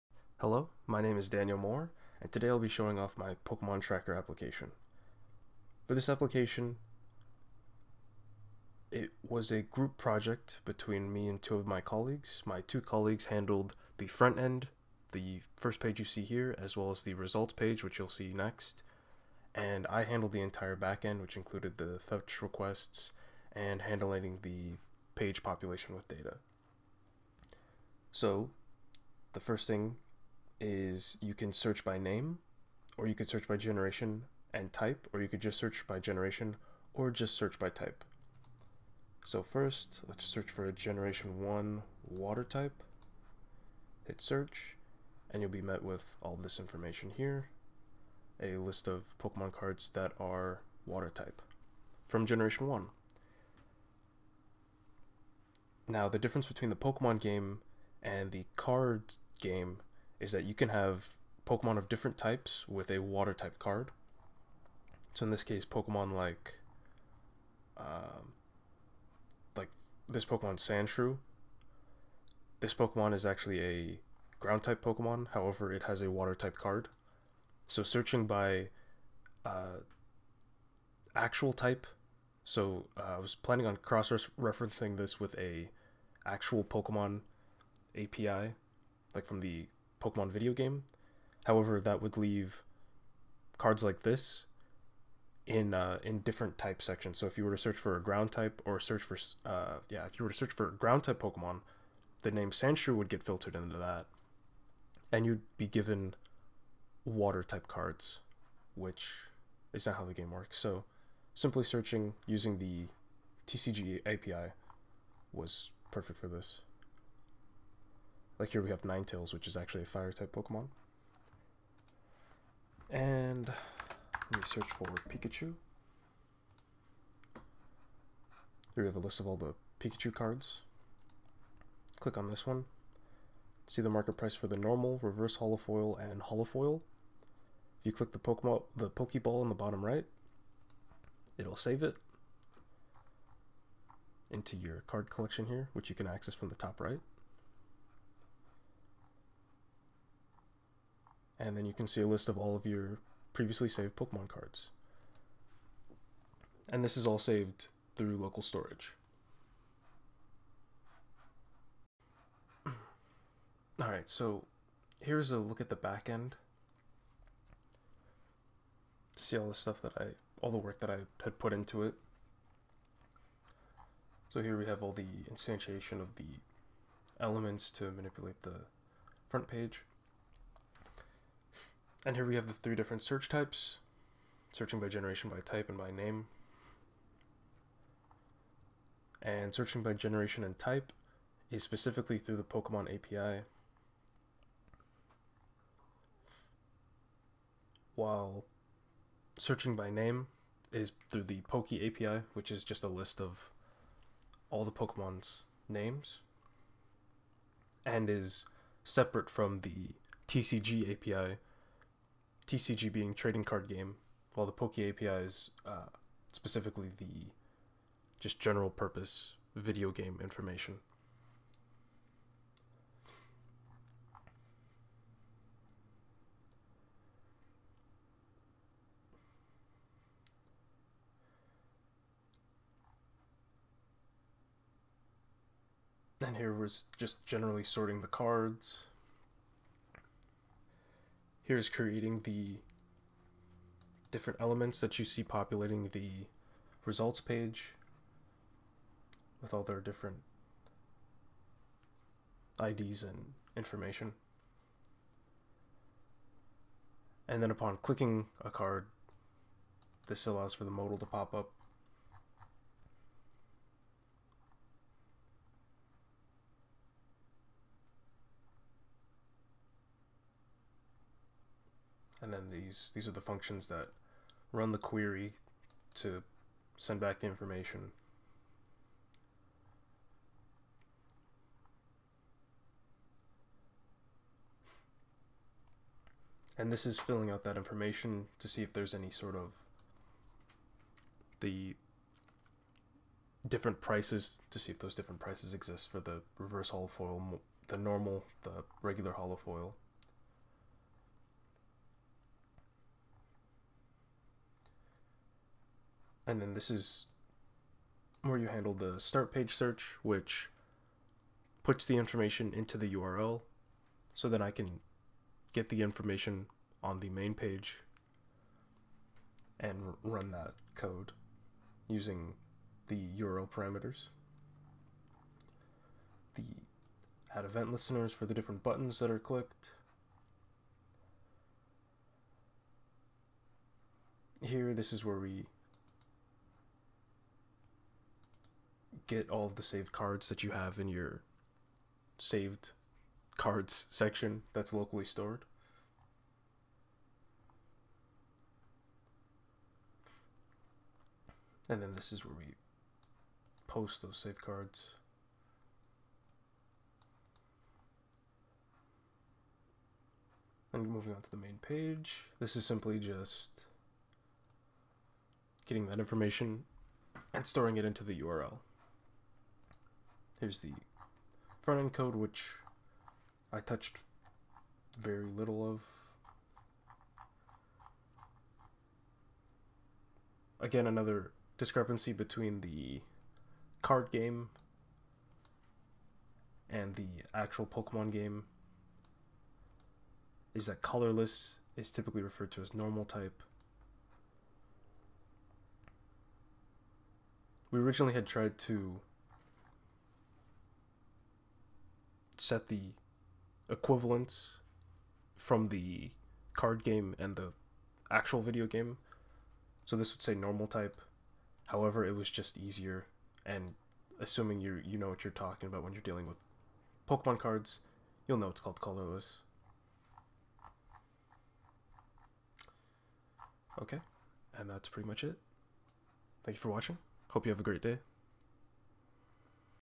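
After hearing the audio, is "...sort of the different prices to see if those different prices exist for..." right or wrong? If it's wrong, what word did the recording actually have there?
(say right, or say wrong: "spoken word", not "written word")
right.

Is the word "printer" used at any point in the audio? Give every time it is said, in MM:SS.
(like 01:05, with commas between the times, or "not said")
not said.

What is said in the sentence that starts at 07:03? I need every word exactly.
Okay, and that's pretty much it.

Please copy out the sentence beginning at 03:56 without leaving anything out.
And here was just generally sorting the cards.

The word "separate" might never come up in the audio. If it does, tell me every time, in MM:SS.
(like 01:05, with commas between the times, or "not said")
03:28.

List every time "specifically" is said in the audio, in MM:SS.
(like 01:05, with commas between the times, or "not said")
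03:11, 03:36.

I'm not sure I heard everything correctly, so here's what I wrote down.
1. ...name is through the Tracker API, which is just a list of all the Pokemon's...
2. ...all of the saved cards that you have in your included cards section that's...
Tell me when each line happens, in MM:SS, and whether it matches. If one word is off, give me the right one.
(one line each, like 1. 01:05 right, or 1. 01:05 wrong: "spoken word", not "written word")
1. 03:19 wrong: "Poke", not "Tracker"
2. 05:39 wrong: "saved", not "included".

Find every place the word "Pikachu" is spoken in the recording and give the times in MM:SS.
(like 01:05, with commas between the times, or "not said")
02:05, 02:09.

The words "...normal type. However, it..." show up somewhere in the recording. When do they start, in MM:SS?
06:50.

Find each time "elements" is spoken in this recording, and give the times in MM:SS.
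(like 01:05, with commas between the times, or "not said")
02:57, 04:04.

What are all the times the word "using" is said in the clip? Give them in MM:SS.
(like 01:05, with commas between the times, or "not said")
01:52, 05:21.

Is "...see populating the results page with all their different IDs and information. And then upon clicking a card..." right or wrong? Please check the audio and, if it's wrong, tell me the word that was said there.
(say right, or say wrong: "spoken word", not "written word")
right.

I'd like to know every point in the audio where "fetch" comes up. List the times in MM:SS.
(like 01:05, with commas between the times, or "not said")
00:21.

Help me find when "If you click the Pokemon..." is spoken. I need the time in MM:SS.
02:17.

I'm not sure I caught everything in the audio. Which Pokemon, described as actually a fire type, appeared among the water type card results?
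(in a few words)
Ninetales.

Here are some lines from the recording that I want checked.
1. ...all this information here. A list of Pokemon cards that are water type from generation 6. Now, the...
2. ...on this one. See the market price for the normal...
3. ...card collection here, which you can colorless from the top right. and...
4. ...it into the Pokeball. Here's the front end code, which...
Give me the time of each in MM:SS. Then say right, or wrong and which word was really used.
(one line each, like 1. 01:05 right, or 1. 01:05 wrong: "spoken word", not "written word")
1. 00:46 wrong: "1", not "6"
2. 02:12 right
3. 02:24 wrong: "access", not "colorless"
4. 06:07 wrong: "URL", not "Pokeball".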